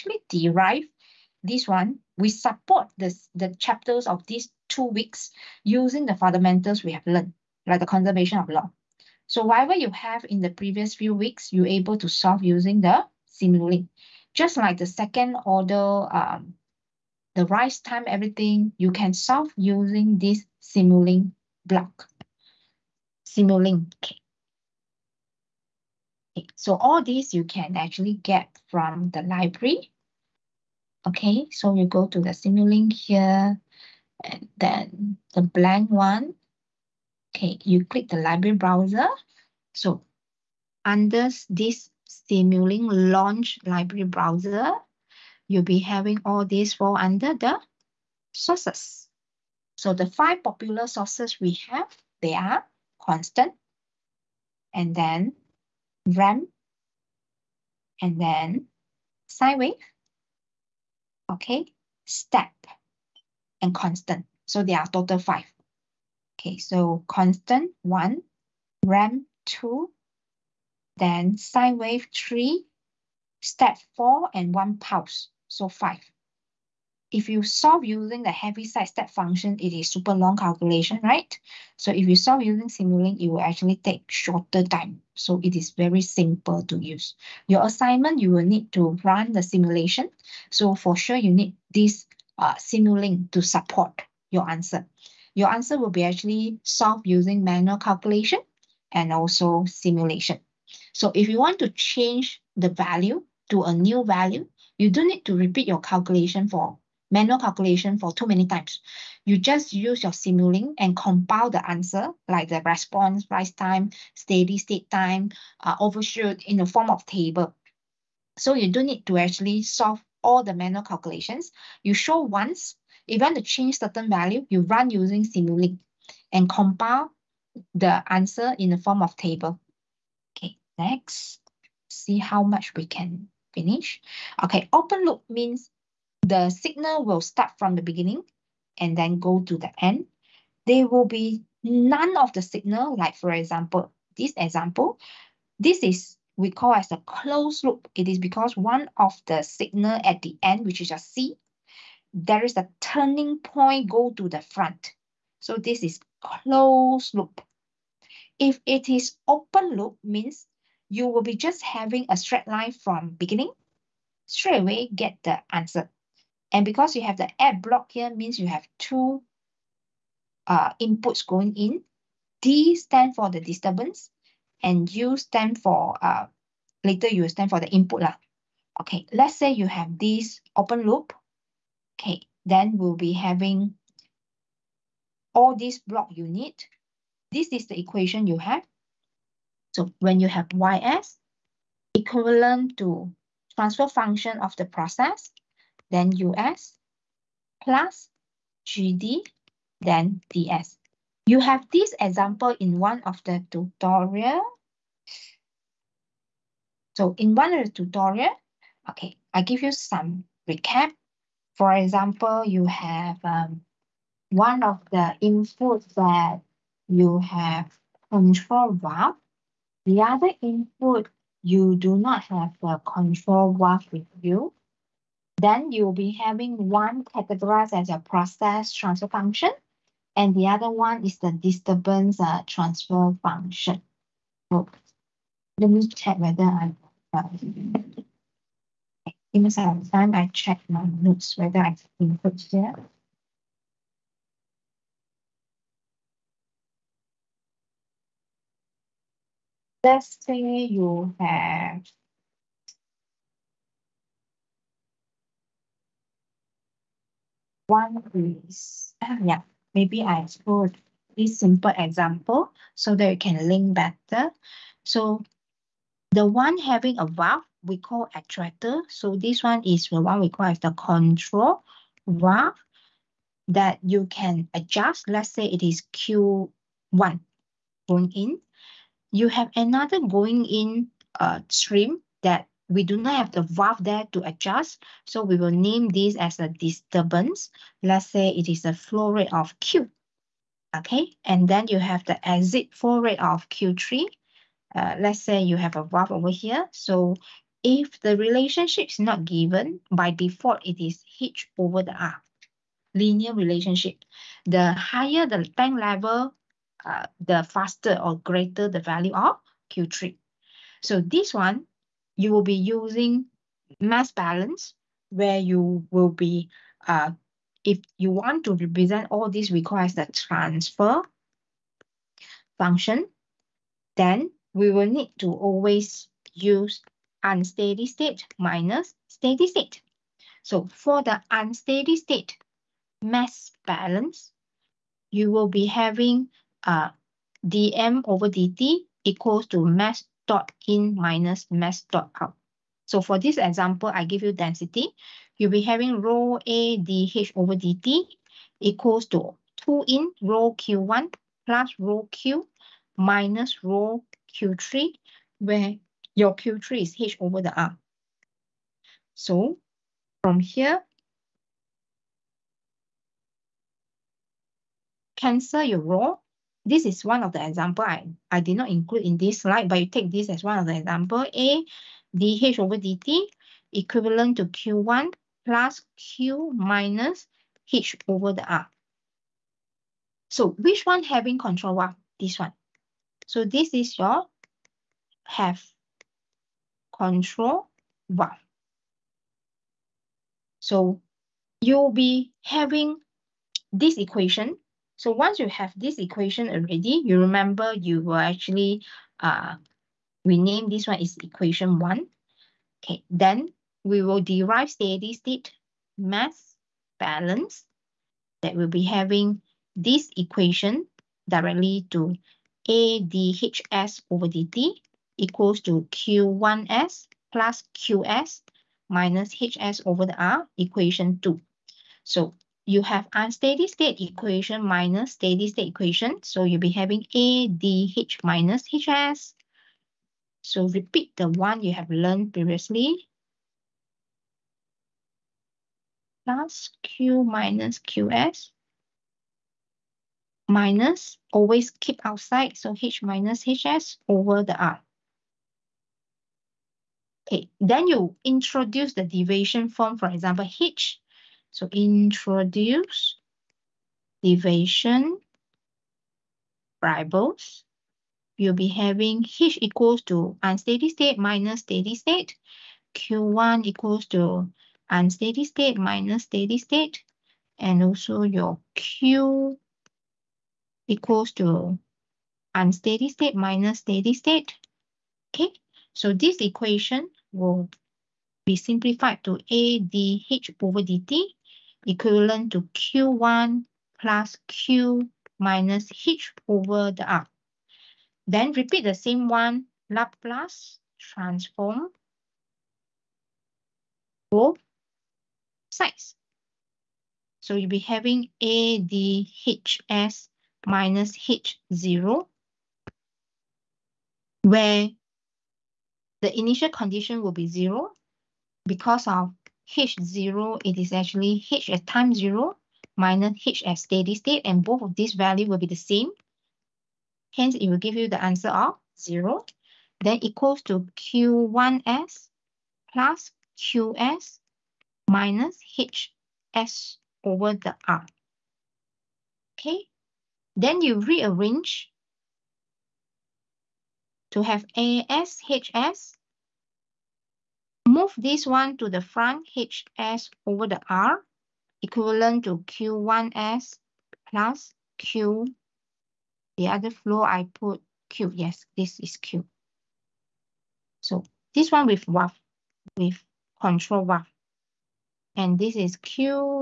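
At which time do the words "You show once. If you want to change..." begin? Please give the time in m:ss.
2:01.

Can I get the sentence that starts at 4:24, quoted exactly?
So the one having a valve we call attractor.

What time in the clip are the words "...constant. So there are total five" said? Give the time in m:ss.
1:03.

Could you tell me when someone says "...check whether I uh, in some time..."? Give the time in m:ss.
3:55.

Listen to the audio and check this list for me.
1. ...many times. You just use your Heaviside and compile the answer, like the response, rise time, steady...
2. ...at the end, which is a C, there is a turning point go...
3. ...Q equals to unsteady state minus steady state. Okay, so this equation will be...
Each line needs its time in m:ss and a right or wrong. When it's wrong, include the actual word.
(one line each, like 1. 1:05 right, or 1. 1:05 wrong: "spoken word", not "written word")
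1. 1:48 wrong: "Simulink", not "Heaviside"
2. 2:30 right
3. 7:48 right.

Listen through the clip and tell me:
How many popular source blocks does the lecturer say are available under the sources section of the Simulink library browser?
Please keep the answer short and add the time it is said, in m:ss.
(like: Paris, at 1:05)
5, at 0:50.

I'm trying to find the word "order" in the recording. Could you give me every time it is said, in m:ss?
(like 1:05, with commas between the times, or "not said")
0:15.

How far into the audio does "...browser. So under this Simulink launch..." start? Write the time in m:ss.
0:38.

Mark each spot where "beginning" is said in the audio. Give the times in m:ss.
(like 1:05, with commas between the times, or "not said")
2:17, 2:43.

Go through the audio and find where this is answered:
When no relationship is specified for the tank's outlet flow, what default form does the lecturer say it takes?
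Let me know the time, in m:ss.
5:02.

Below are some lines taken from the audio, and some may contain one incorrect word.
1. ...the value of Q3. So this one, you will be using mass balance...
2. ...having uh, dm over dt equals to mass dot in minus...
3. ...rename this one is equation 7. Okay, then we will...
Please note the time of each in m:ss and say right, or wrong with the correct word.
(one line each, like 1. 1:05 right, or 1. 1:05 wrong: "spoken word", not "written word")
1. 5:08 right
2. 5:35 right
3. 6:40 wrong: "1", not "7".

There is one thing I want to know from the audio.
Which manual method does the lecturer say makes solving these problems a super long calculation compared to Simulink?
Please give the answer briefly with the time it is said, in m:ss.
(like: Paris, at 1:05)
Heaviside step function, at 1:18.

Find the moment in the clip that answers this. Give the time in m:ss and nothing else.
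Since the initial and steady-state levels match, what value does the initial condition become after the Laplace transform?
8:27.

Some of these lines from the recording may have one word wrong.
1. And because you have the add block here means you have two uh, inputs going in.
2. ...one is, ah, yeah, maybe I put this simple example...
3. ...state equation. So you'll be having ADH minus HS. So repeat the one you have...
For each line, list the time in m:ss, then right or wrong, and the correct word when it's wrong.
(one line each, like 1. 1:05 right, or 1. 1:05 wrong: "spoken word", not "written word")
1. 2:46 right
2. 4:17 right
3. 7:05 right.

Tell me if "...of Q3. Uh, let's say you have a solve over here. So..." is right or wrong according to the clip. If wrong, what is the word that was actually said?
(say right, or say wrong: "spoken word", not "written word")
wrong: "valve", not "solve".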